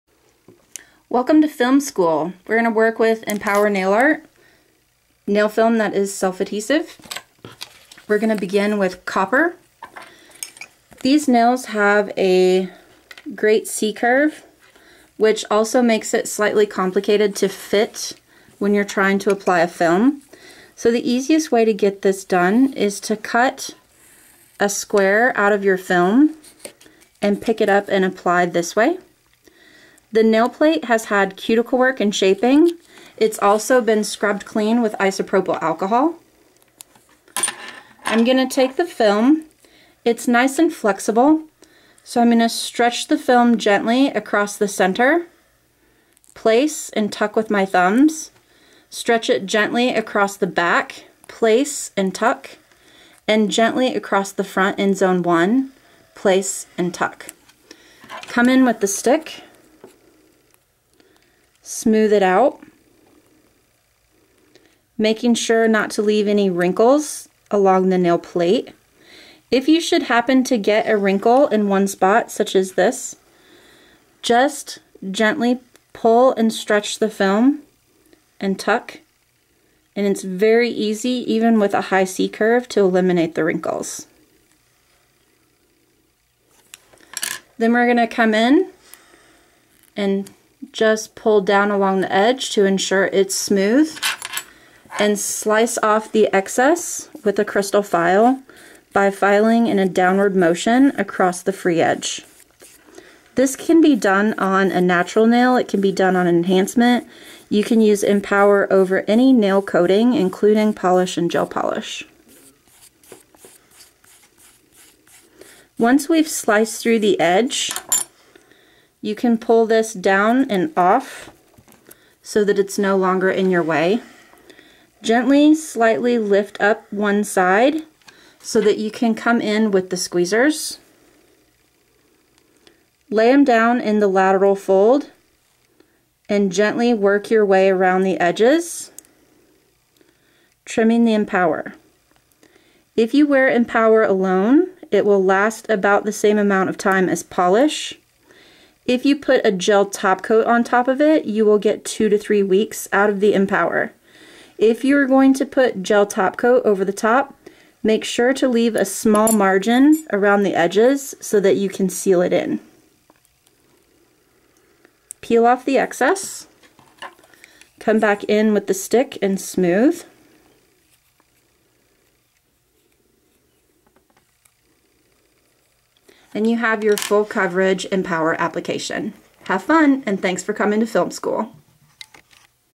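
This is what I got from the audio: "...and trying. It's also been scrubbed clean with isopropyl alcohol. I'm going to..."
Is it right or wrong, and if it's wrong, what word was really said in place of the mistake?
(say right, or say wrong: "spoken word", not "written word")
wrong: "shaping", not "trying".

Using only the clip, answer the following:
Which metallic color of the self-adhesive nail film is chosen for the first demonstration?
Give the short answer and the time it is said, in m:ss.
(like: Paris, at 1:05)
copper, at 0:09.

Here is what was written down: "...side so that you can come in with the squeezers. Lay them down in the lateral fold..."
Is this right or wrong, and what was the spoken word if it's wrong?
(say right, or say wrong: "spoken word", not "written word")
right.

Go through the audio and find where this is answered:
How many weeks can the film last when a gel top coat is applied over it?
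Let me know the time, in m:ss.
2:31.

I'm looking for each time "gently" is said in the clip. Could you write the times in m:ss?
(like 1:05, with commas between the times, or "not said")
0:43, 0:49, 0:53, 1:15, 2:05, 2:16.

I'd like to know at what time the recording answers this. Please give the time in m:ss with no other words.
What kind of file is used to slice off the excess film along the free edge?
1:37.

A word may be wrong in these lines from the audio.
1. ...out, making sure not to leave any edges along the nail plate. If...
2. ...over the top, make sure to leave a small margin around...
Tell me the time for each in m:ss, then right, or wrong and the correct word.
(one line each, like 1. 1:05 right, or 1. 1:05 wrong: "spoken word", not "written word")
1. 1:02 wrong: "wrinkles", not "edges"
2. 2:36 right.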